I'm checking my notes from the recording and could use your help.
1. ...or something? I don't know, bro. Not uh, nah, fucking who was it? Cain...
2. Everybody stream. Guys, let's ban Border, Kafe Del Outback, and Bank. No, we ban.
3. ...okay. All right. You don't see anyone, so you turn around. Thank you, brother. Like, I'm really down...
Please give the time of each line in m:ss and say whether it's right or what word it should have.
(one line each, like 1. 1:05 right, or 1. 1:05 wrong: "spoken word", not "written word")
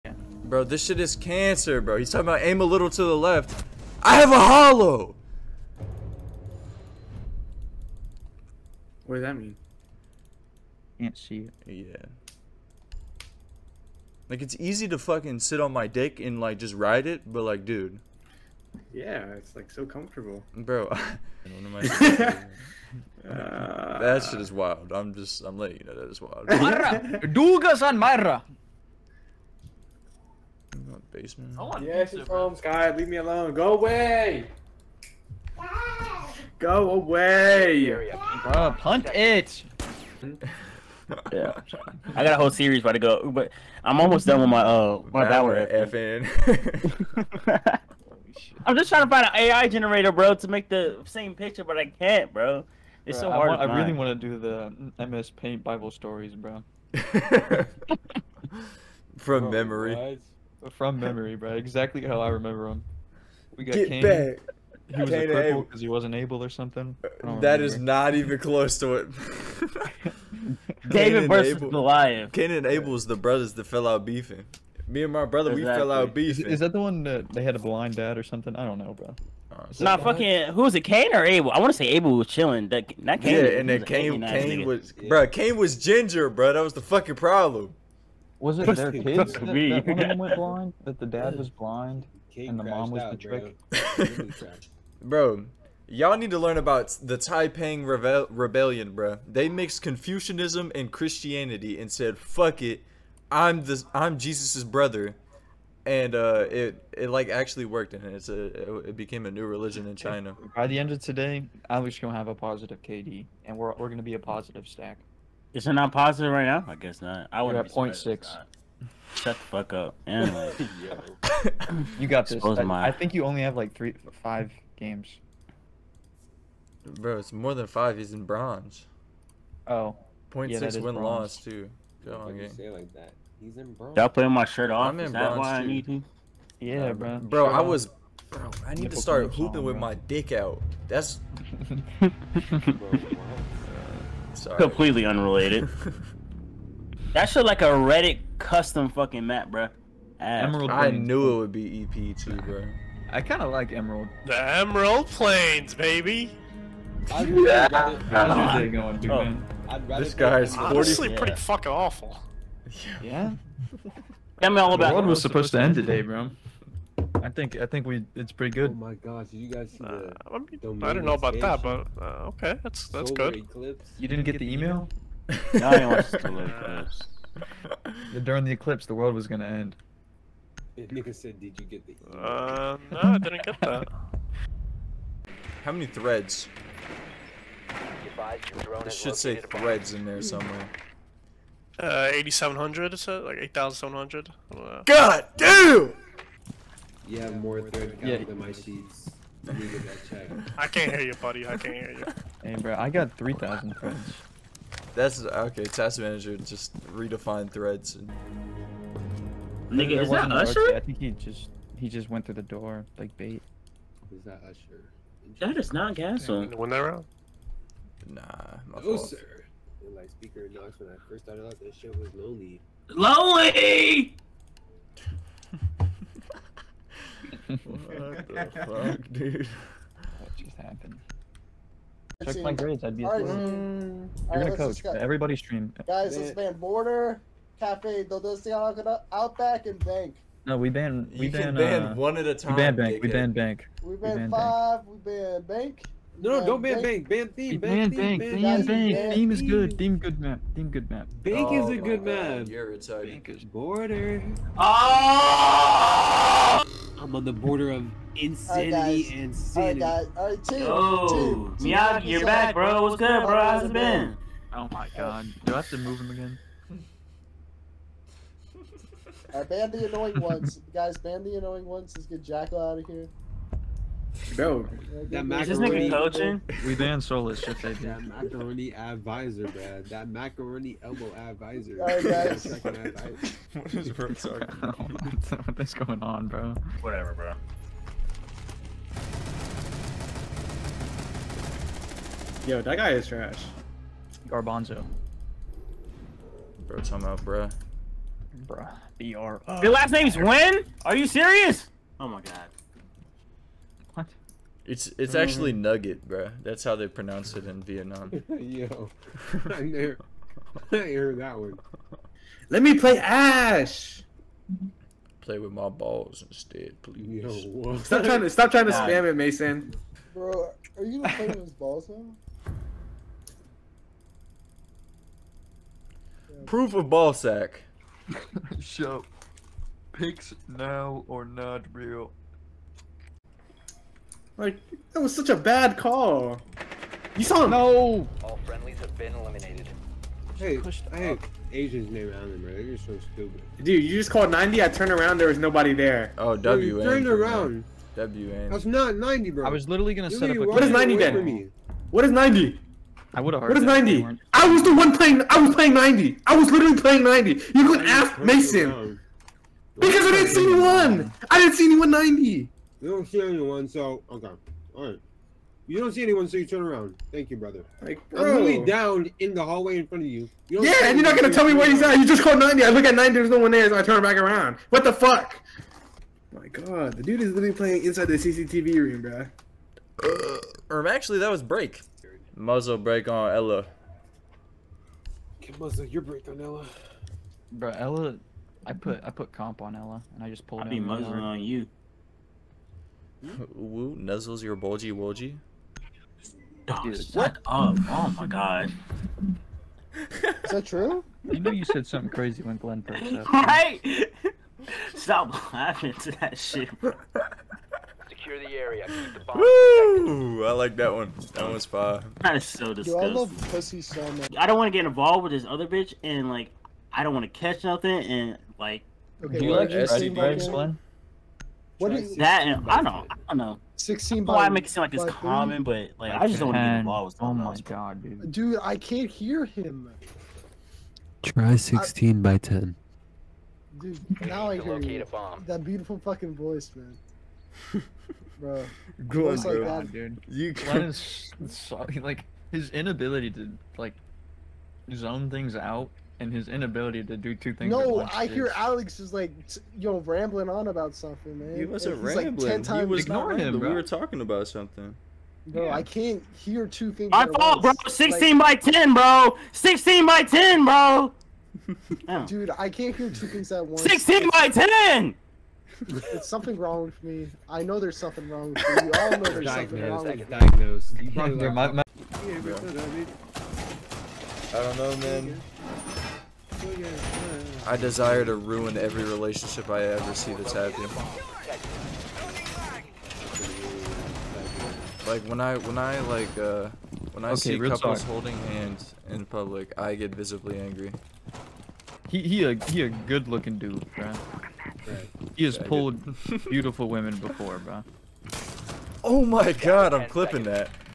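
1. 1:18 right
2. 3:54 right
3. 6:04 right.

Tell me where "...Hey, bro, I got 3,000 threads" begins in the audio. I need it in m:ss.
3:22.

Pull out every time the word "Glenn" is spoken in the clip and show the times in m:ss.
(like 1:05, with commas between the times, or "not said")
6:42, 7:00.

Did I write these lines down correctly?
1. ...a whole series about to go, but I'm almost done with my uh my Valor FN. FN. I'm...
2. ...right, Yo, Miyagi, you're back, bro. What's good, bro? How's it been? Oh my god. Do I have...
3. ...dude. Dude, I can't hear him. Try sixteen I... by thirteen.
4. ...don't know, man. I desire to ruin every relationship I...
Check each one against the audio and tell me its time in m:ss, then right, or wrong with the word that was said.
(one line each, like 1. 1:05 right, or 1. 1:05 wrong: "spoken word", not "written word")
1. 0:42 right
2. 4:20 right
3. 7:08 wrong: "ten", not "thirteen"
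4. 7:54 right.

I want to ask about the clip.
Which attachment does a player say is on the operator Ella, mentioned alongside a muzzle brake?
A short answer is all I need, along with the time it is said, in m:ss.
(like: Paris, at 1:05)
comp, at 6:29.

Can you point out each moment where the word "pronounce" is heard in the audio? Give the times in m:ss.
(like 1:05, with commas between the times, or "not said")
5:06.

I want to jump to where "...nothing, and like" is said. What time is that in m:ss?
6:57.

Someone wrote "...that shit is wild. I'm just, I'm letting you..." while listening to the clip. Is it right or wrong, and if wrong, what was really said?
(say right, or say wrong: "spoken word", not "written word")
right.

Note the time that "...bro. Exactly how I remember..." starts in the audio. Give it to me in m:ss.
1:01.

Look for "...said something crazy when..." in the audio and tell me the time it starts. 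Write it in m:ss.
6:41.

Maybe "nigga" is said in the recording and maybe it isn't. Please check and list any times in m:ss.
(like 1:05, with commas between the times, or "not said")
3:29, 4:35.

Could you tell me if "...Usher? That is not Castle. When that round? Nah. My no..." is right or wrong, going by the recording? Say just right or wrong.
right.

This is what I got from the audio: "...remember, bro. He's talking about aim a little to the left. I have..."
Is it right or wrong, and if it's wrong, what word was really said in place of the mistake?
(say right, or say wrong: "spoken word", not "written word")
wrong: "cancer", not "remember".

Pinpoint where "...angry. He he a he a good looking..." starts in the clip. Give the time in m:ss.
8:10.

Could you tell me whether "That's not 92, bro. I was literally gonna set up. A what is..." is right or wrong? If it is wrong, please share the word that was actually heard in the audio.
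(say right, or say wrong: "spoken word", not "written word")
wrong: "90", not "92".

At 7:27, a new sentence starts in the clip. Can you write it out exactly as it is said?
No, I hear Alex is like, yo, rambling on about something, man.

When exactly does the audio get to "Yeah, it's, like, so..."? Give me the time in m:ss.
0:18.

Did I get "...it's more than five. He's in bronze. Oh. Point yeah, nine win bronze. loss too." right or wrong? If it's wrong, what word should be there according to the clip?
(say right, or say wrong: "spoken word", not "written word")
wrong: "six", not "nine".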